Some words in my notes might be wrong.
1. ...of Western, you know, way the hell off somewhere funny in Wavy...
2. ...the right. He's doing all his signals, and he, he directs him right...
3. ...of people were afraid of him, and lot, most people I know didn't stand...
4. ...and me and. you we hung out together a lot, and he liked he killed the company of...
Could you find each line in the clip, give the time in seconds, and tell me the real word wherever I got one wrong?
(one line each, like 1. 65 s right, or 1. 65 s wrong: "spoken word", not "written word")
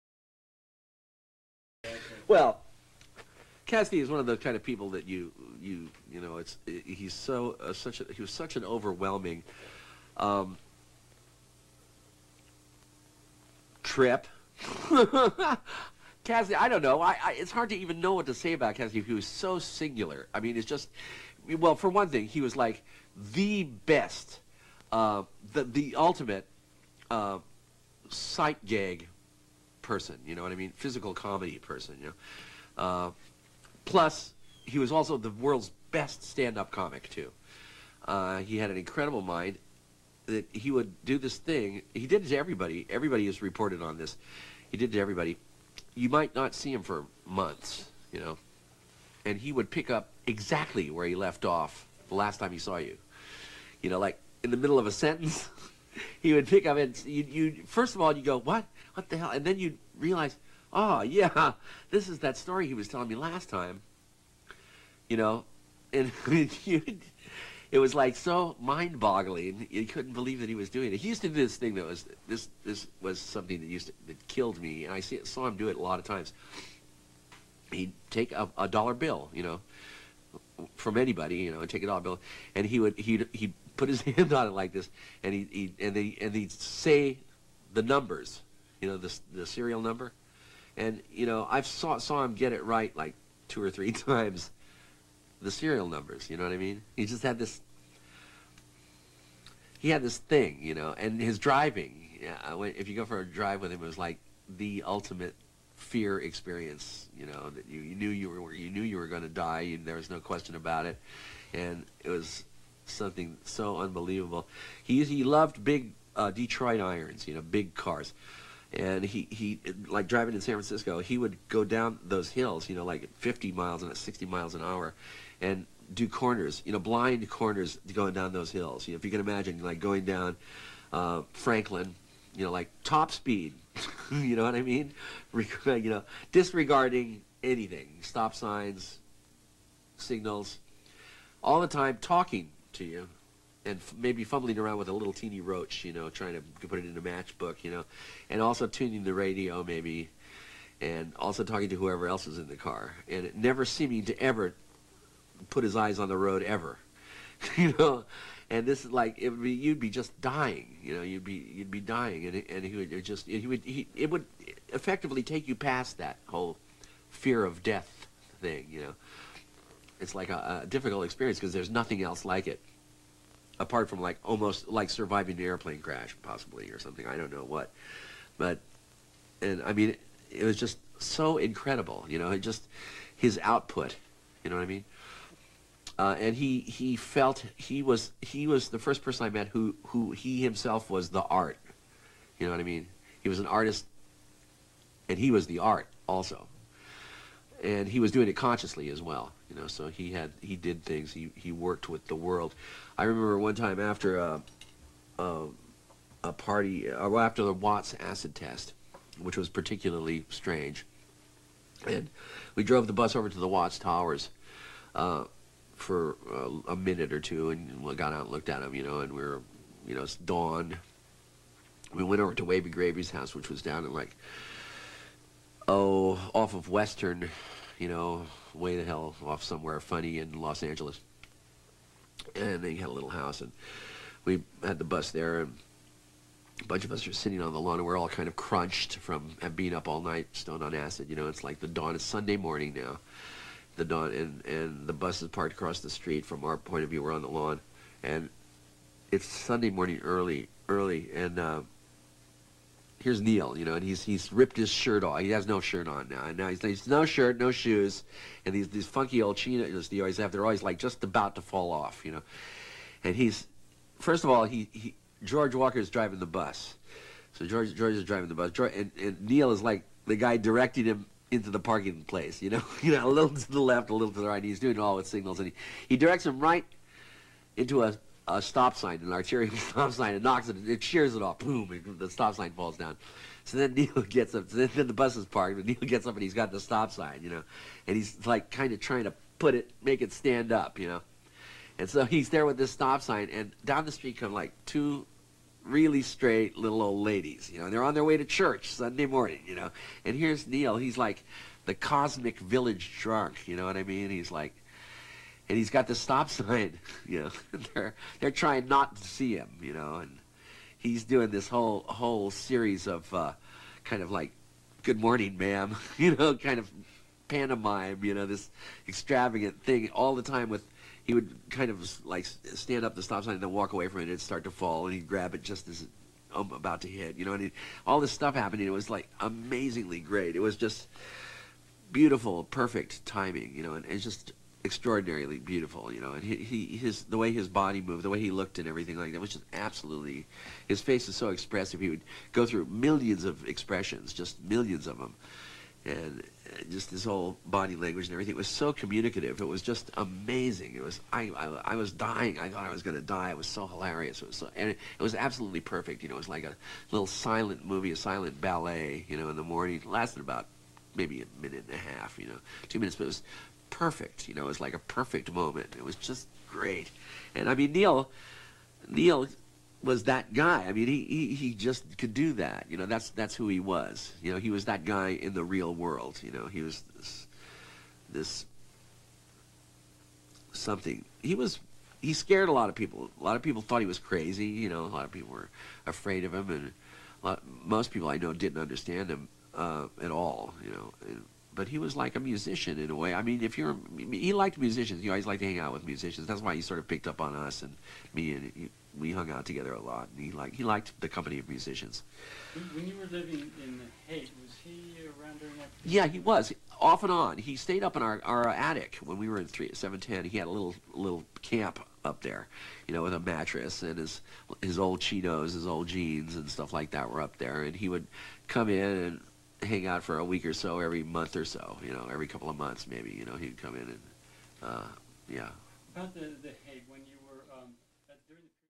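1. 226 s wrong: "Los", not "Wavy"
2. 274 s right
3. 385 s wrong: "understand", not "stand"
4. 397 s wrong: "liked", not "killed".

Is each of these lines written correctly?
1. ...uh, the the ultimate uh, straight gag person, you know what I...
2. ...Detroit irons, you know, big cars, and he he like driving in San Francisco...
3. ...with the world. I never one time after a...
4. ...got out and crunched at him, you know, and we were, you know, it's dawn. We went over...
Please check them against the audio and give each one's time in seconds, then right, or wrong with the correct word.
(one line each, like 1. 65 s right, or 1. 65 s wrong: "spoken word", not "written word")
1. 24 s wrong: "sight", not "straight"
2. 116 s right
3. 201 s wrong: "remember", not "never"
4. 217 s wrong: "looked", not "crunched".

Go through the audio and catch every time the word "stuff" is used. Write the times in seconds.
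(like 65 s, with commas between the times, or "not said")
328 s, 416 s.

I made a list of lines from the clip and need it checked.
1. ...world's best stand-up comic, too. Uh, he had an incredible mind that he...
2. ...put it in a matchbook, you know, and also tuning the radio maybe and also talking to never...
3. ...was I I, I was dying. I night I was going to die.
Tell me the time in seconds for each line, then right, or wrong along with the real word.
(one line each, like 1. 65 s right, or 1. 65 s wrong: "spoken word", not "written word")
1. 35 s right
2. 146 s wrong: "whoever", not "never"
3. 350 s wrong: "thought", not "night".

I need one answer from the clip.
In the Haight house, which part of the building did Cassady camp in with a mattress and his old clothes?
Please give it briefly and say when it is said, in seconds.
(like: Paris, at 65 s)
attic, at 408 s.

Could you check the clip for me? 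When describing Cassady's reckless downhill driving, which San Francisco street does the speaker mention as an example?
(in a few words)
Franklin.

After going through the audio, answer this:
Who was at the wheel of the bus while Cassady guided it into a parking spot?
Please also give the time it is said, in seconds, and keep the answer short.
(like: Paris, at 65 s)
George Walker, at 265 s.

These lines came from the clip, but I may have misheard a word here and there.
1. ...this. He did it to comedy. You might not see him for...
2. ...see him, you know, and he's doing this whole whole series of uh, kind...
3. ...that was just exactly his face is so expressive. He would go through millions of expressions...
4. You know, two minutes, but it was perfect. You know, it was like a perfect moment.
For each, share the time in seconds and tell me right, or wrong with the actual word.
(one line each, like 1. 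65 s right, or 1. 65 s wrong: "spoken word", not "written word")
1. 43 s wrong: "everybody", not "comedy"
2. 309 s right
3. 339 s wrong: "absolutely", not "exactly"
4. 362 s right.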